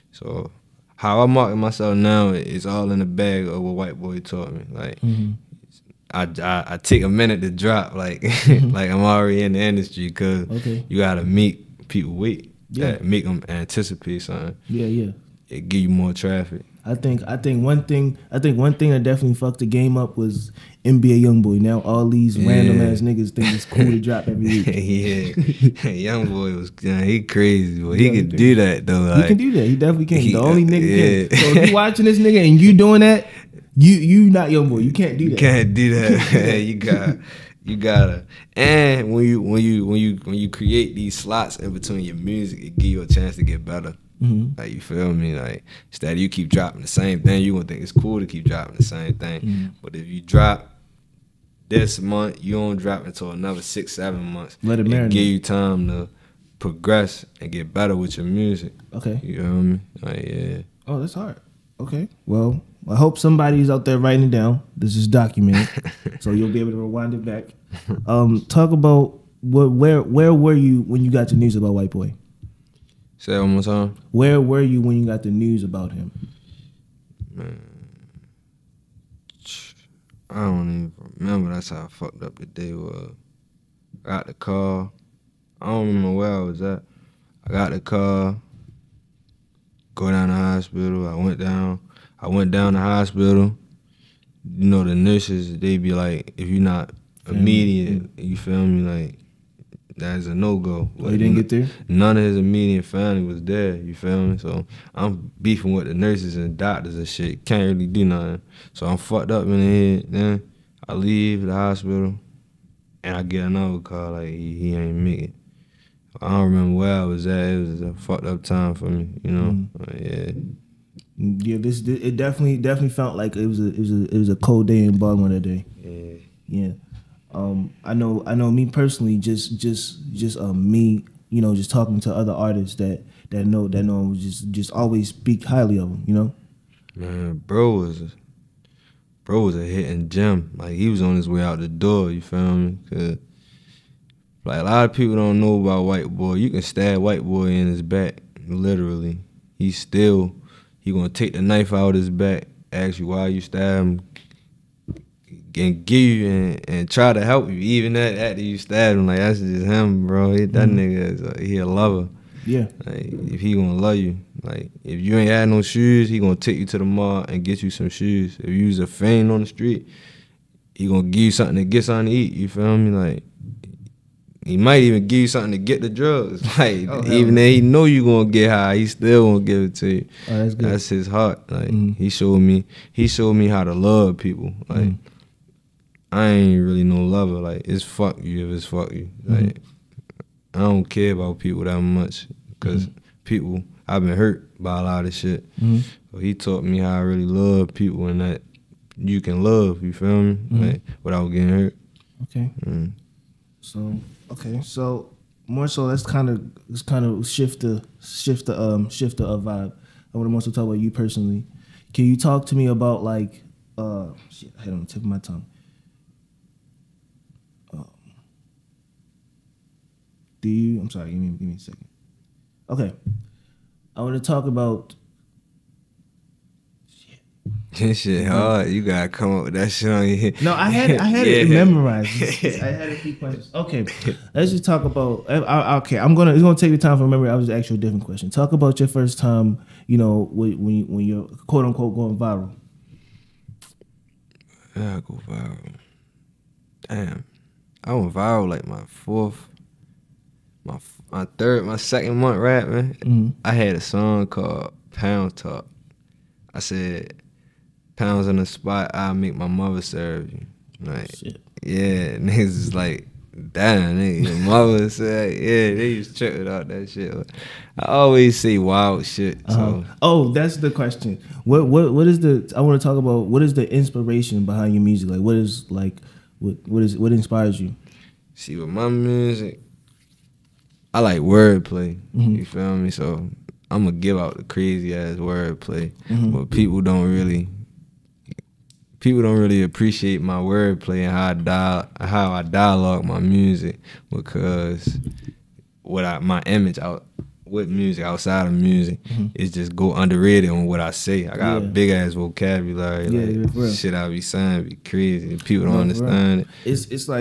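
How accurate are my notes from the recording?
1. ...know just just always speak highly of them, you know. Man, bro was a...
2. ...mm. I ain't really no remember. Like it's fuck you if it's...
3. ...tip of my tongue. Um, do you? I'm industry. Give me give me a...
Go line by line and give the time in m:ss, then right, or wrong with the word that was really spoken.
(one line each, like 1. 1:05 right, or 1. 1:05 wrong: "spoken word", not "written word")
1. 2:13 right
2. 3:04 wrong: "lover", not "remember"
3. 3:34 wrong: "sorry", not "industry".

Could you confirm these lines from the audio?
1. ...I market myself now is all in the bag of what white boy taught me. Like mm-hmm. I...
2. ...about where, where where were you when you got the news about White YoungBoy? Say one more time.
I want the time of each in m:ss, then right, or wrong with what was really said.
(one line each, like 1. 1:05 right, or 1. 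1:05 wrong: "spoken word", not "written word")
1. 0:01 right
2. 1:08 wrong: "Boy", not "YoungBoy".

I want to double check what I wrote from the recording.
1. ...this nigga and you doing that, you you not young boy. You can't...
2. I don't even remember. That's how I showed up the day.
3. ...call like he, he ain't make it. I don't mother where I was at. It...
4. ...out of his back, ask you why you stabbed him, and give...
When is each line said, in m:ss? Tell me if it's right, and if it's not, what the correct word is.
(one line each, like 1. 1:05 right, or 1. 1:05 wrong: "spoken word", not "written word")
1. 0:32 right
2. 1:20 wrong: "fucked", not "showed"
3. 1:53 wrong: "remember", not "mother"
4. 2:31 right.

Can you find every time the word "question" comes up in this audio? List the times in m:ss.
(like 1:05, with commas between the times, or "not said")
3:53, 3:58, 4:30.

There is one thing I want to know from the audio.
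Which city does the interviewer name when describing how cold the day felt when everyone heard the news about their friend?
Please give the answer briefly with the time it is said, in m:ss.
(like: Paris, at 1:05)
Baltimore, at 2:04.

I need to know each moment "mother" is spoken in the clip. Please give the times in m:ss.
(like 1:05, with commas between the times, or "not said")
4:19, 4:24.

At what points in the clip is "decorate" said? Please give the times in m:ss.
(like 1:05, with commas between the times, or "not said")
not said.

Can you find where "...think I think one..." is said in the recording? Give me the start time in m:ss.
0:16.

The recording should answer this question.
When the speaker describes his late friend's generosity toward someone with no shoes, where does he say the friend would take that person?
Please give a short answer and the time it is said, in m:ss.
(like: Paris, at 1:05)
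the mall, at 2:46.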